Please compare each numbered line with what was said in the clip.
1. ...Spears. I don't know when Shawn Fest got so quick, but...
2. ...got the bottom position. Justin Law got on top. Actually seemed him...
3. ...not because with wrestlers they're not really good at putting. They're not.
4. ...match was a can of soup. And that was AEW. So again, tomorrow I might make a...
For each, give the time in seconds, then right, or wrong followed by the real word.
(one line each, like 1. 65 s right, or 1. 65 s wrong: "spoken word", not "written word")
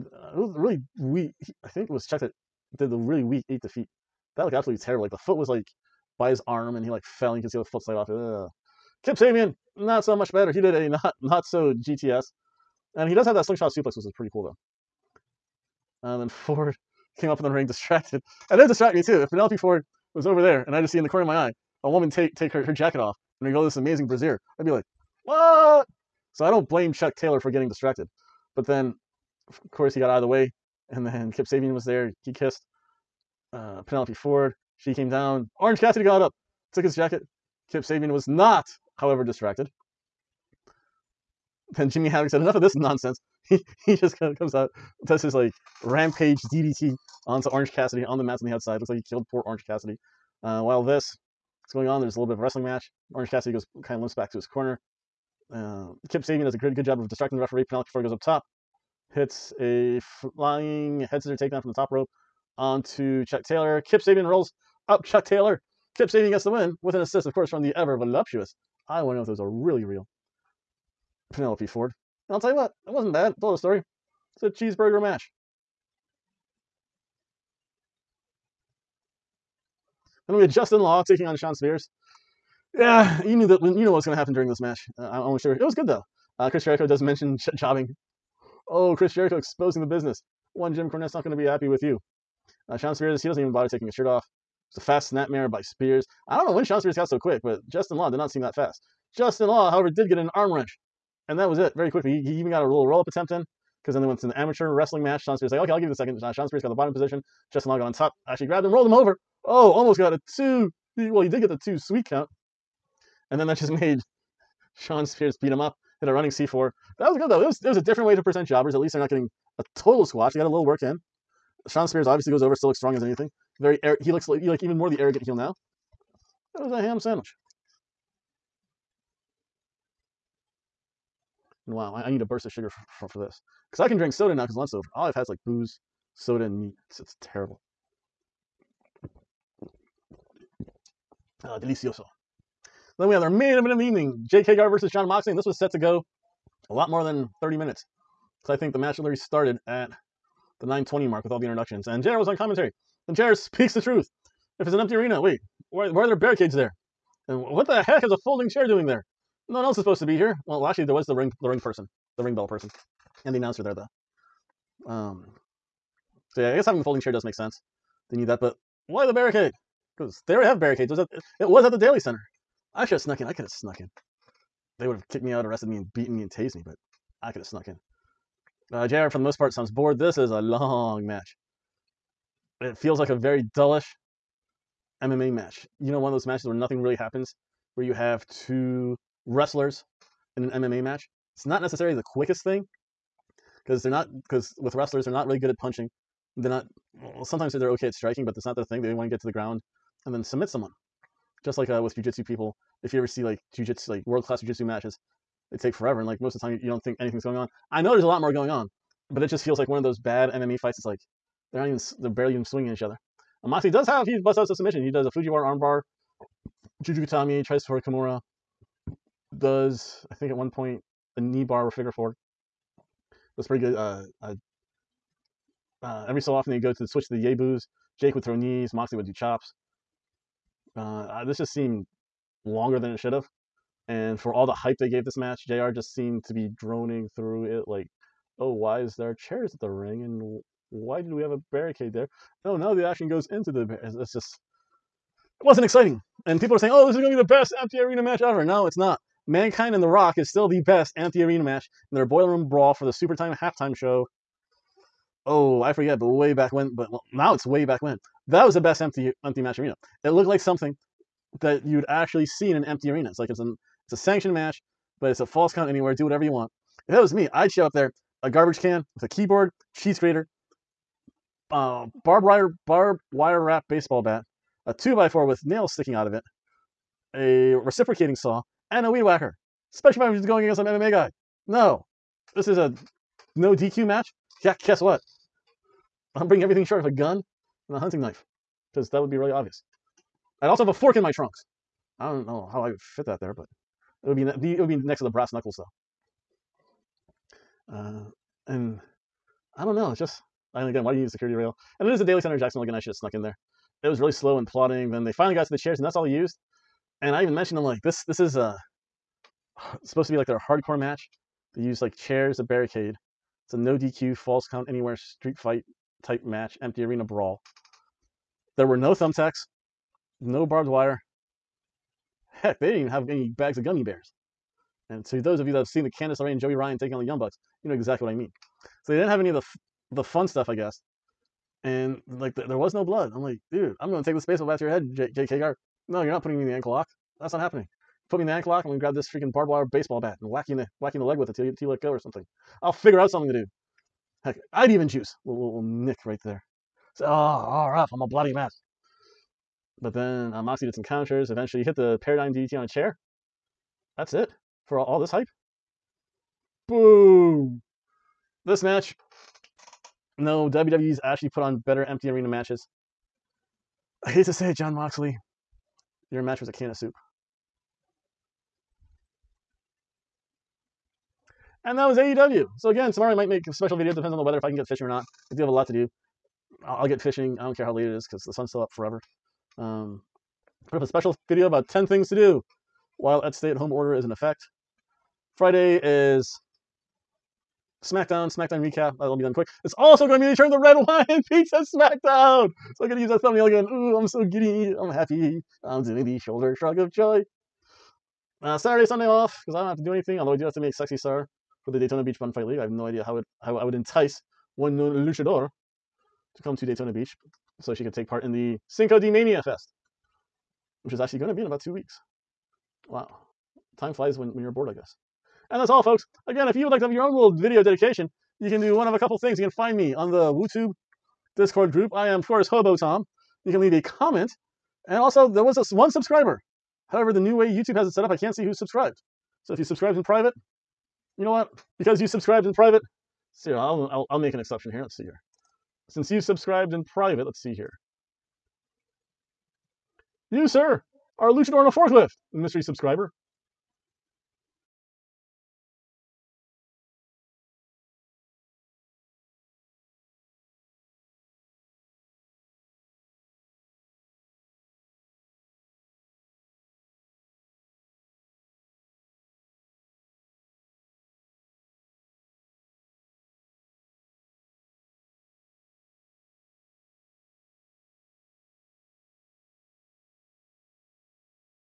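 1. 95 s wrong: "Spears", not "Fest"
2. 106 s wrong: "grabbed", not "seemed"
3. 193 s wrong: "punching", not "putting"
4. 366 s right.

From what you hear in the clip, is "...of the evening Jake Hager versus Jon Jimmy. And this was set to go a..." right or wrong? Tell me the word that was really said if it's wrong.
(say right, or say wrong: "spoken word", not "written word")
wrong: "Moxley", not "Jimmy".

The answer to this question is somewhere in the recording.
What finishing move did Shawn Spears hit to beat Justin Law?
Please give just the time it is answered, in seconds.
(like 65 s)
116 s.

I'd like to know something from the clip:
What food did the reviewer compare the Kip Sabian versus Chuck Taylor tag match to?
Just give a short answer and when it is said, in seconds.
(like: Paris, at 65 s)
cheeseburger, at 74 s.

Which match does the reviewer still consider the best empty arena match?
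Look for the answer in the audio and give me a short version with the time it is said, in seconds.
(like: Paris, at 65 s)
Mankind and The Rock, at 249 s.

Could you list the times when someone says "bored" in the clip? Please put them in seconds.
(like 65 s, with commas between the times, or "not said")
179 s, 414 s.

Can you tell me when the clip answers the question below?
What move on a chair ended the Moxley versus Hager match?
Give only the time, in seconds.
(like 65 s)
352 s.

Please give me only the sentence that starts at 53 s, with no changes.
Orange Cassidy goes kind of limps back to his corner.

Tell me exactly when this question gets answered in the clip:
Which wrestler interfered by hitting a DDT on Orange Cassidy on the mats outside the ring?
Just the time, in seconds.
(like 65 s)
41 s.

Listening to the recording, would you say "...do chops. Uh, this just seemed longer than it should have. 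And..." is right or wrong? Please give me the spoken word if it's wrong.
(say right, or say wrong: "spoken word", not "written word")
right.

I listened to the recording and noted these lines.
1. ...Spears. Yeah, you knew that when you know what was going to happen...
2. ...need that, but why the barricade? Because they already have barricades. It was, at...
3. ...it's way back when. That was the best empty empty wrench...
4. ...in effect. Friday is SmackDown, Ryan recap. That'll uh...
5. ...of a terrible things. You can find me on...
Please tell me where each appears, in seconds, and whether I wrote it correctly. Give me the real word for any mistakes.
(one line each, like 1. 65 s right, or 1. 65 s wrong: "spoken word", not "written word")
1. 81 s right
2. 168 s right
3. 257 s wrong: "match", not "wrench"
4. 384 s wrong: "SmackDown", not "Ryan"
5. 418 s wrong: "couple", not "terrible".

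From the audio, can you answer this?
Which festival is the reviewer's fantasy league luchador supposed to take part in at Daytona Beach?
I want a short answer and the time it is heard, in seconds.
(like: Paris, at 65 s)
Cinco de Mania Fest, at 408 s.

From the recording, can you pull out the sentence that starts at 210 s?
It's like they're not even they're barely even swinging each other.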